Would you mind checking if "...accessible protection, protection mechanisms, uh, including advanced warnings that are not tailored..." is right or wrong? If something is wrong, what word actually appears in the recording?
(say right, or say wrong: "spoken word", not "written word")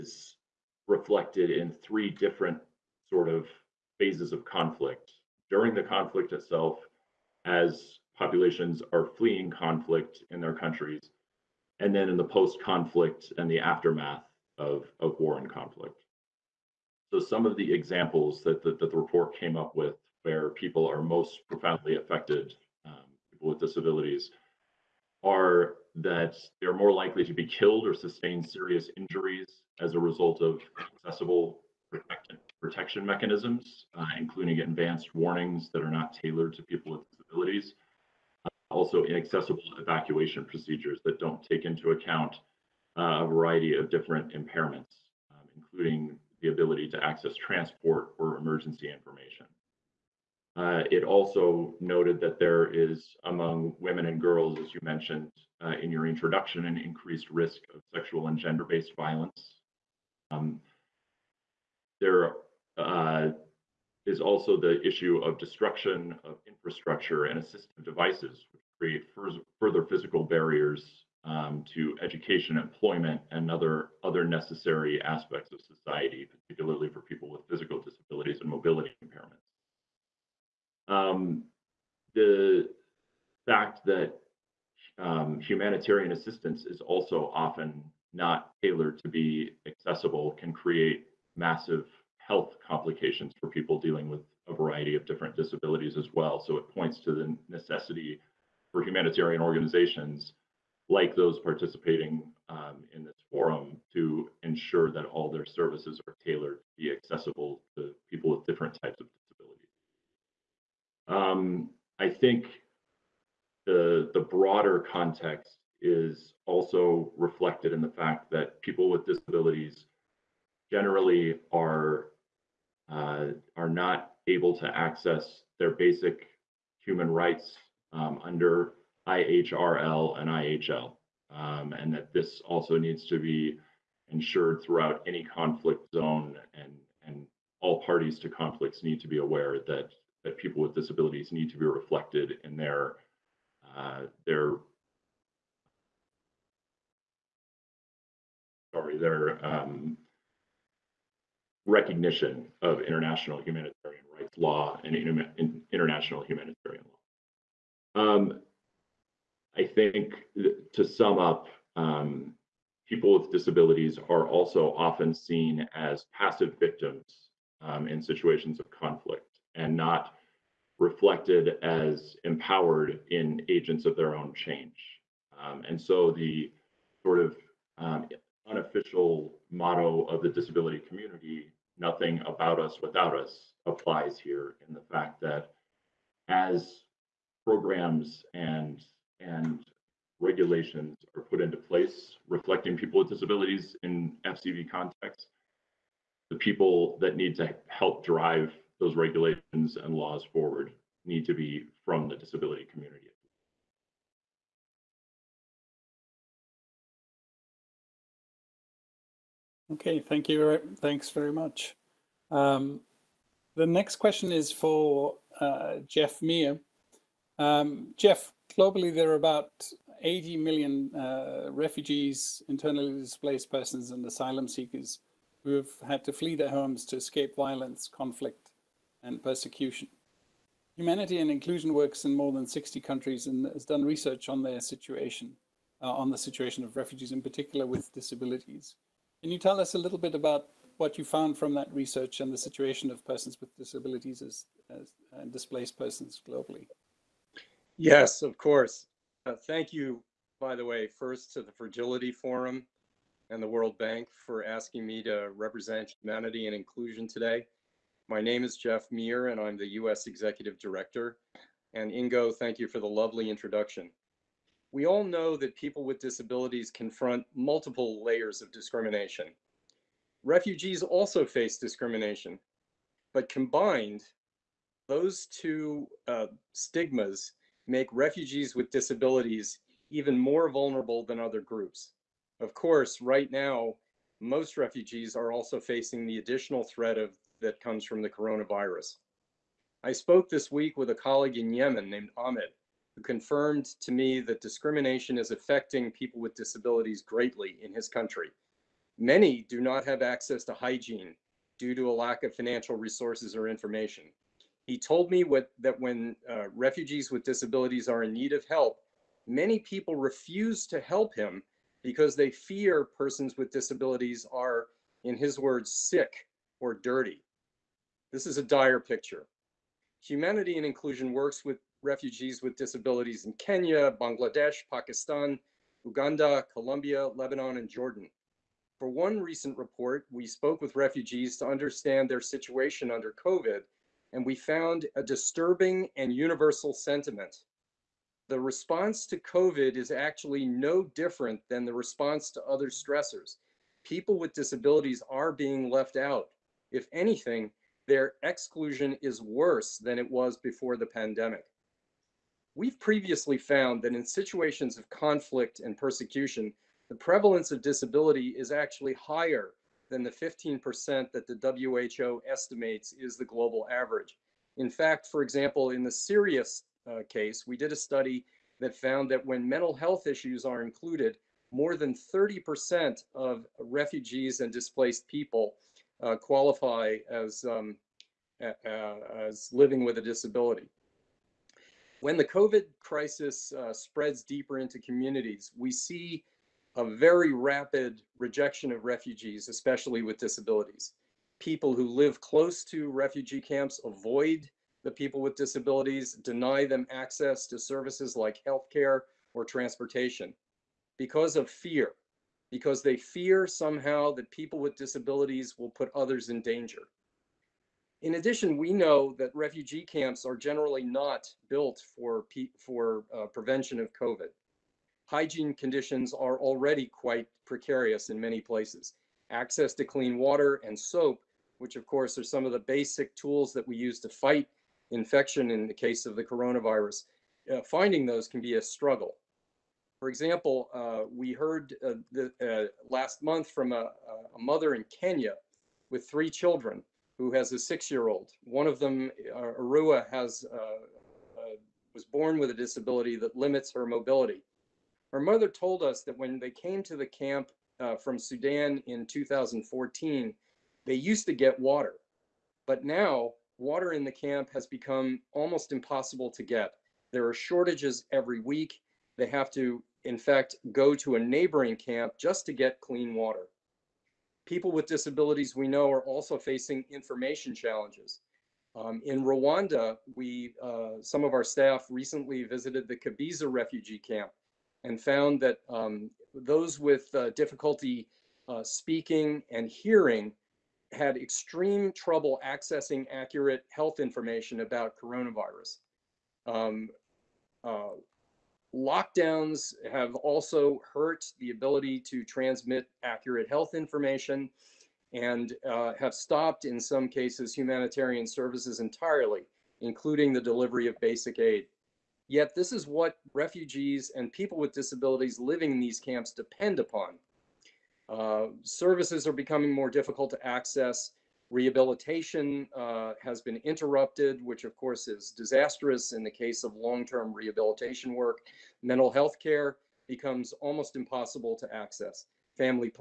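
right.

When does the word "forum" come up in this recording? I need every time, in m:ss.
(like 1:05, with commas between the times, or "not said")
1:43, 4:12.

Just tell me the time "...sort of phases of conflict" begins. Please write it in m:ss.
0:03.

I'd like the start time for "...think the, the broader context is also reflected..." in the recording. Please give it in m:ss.
1:52.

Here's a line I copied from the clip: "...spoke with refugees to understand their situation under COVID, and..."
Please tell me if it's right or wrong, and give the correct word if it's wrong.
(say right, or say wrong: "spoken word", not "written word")
right.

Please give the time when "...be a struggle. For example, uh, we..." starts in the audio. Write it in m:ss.
7:08.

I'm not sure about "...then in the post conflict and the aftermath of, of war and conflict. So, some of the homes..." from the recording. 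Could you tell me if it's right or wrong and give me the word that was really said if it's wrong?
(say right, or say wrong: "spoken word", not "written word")
wrong: "examples", not "homes".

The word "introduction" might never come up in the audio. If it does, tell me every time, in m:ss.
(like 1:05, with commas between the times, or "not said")
0:56, 4:23.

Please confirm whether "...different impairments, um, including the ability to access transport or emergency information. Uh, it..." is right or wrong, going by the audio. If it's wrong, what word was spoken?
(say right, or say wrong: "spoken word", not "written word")
right.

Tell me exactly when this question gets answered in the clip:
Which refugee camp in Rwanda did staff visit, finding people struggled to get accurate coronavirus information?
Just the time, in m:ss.
7:52.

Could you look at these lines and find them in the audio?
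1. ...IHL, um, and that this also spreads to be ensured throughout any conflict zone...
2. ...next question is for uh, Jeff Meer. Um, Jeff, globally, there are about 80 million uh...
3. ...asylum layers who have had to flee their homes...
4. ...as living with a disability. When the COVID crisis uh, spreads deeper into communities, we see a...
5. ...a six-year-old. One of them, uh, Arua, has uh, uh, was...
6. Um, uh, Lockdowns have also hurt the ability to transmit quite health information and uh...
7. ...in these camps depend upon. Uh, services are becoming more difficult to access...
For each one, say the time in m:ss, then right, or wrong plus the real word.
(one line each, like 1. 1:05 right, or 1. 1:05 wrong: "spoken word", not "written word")
1. 2:10 wrong: "needs", not "spreads"
2. 3:33 right
3. 3:44 wrong: "seekers", not "layers"
4. 6:19 right
5. 7:17 right
6. 8:06 wrong: "accurate", not "quite"
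7. 8:25 right.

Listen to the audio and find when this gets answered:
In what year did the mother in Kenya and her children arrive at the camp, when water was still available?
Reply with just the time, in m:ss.
7:29.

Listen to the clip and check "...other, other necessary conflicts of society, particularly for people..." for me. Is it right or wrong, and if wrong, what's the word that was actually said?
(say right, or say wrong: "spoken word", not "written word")
wrong: "aspects", not "conflicts".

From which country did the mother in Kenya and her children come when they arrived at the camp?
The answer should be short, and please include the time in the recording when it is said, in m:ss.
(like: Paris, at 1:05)
Sudan, at 7:28.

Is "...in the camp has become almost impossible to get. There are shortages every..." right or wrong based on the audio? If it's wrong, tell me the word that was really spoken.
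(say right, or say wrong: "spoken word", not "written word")
right.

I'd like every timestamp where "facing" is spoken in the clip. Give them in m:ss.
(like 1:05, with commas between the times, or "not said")
4:45, 7:46.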